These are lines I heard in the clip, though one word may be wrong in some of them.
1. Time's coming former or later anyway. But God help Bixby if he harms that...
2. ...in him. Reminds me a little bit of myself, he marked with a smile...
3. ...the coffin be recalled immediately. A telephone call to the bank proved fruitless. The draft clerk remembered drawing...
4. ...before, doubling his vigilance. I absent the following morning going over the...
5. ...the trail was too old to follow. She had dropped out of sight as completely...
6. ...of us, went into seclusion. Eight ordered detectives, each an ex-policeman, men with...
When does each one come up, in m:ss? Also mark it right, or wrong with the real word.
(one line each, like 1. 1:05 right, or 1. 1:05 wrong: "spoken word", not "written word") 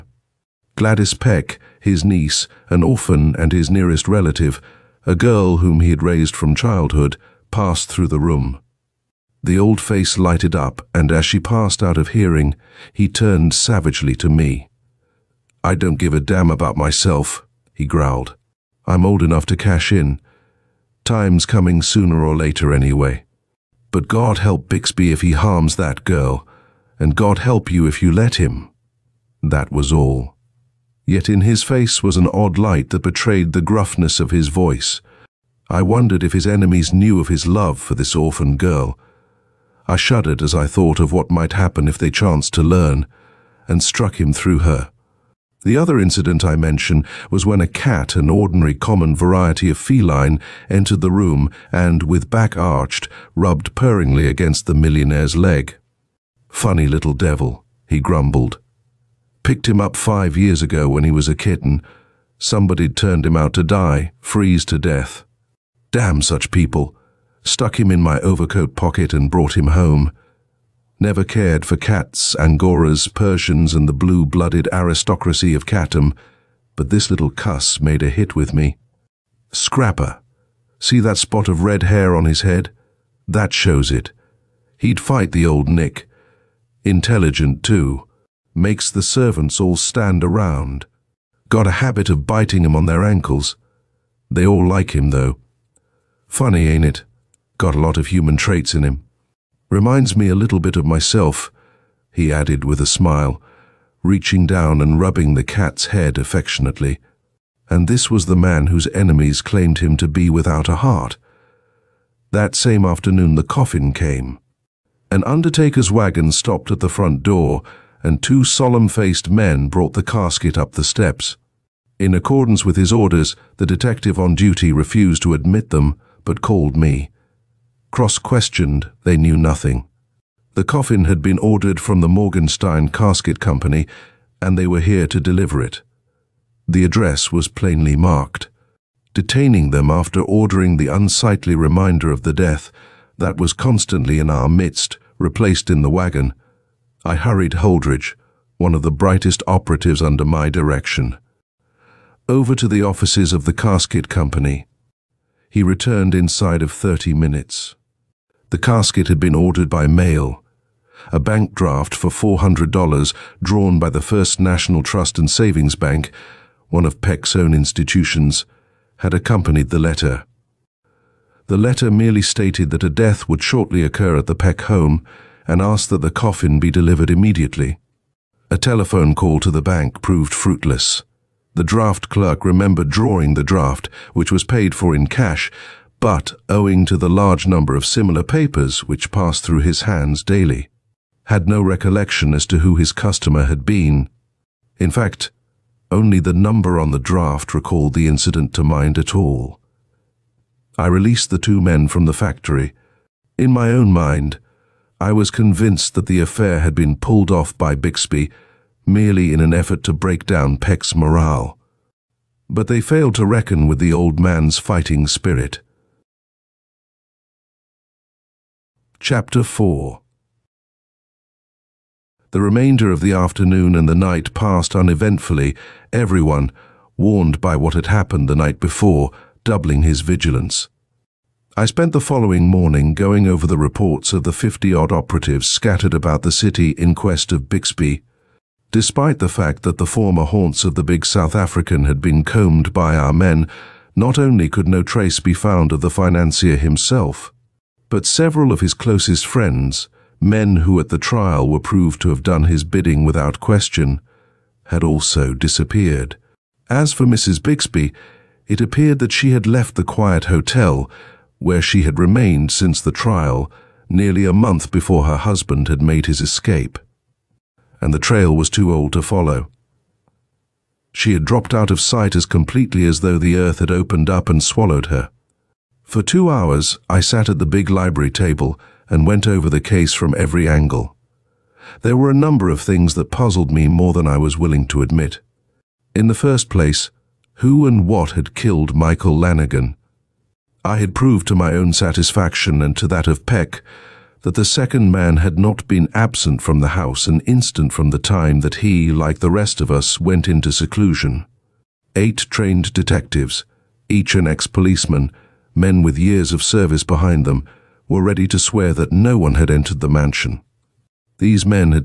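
1. 0:21 wrong: "sooner", not "former"
2. 1:38 wrong: "added", not "marked"
3. 2:56 wrong: "delivered", not "recalled"
4. 3:48 wrong: "spent", not "absent"
5. 4:27 right
6. 4:59 wrong: "trained", not "ordered".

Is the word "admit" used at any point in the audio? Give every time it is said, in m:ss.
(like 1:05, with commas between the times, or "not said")
2:05, 4:44.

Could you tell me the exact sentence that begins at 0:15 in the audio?
I don't give a damn about myself, he growled.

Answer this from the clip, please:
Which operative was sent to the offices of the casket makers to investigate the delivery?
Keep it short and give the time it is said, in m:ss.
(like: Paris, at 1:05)
Holdridge, at 2:27.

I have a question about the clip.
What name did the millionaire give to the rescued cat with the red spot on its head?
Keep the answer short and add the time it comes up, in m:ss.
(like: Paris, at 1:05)
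Scrapper, at 1:19.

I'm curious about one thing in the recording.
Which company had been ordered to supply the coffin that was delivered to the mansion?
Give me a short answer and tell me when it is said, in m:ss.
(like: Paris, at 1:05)
Morgenstein Casket Company, at 2:12.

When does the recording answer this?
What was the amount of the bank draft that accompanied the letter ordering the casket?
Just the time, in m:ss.
2:42.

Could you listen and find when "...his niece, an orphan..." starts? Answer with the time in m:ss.
0:01.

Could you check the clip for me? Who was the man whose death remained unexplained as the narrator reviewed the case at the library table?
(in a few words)
Michael Lanigan.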